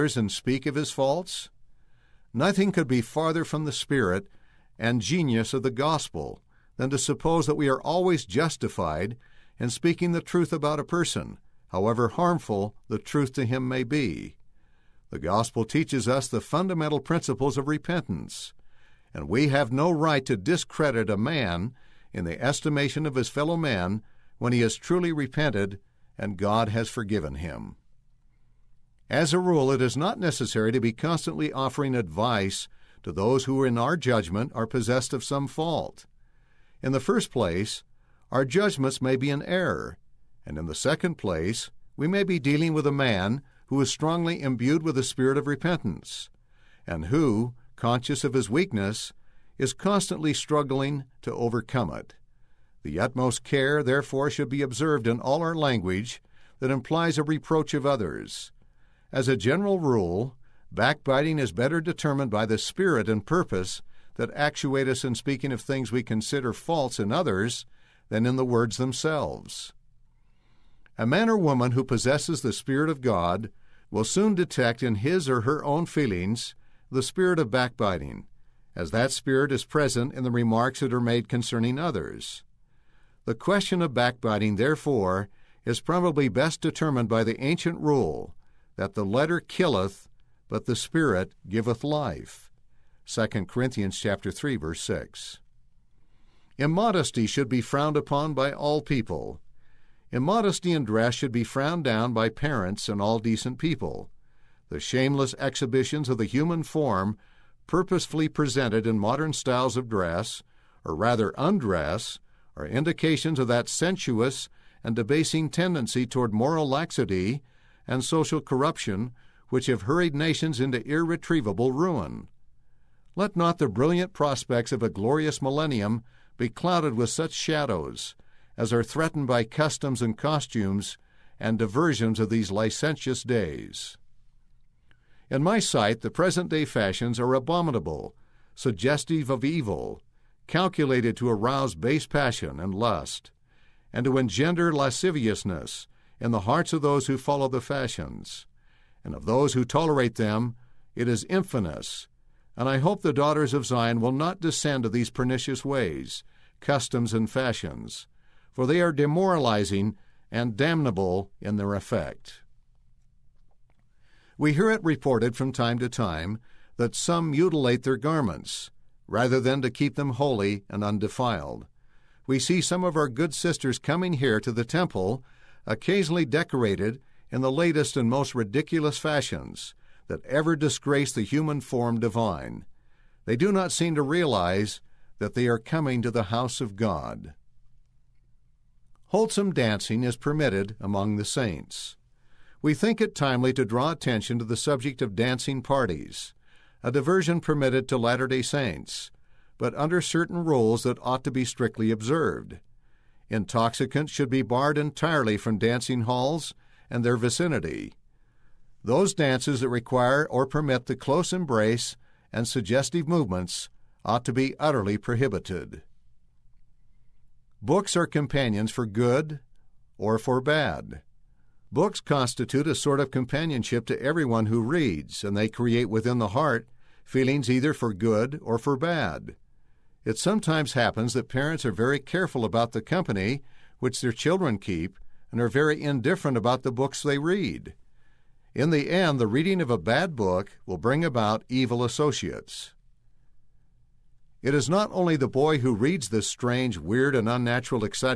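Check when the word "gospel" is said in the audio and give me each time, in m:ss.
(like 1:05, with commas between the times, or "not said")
0:05, 0:15.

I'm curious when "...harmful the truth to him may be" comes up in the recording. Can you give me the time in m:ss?
0:12.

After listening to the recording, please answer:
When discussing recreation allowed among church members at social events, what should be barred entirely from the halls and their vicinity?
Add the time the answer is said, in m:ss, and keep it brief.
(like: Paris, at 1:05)
Intoxicants, at 3:23.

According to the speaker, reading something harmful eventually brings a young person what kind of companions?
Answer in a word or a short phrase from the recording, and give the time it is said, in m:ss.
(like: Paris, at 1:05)
Evil associates, at 4:01.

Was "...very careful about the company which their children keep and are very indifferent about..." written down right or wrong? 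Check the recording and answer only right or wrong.
right.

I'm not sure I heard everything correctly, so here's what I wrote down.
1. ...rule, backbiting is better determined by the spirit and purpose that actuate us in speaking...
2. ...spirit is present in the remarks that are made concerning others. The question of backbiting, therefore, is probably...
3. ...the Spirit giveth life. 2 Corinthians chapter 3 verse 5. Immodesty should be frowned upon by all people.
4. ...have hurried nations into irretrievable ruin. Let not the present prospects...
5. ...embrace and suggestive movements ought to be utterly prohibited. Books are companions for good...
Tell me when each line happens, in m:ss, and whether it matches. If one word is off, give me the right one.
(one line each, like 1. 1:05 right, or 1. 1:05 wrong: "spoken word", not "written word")
1. 0:59 right
2. 1:19 right
3. 1:30 wrong: "6", not "5"
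4. 1:59 wrong: "brilliant", not "present"
5. 3:31 right.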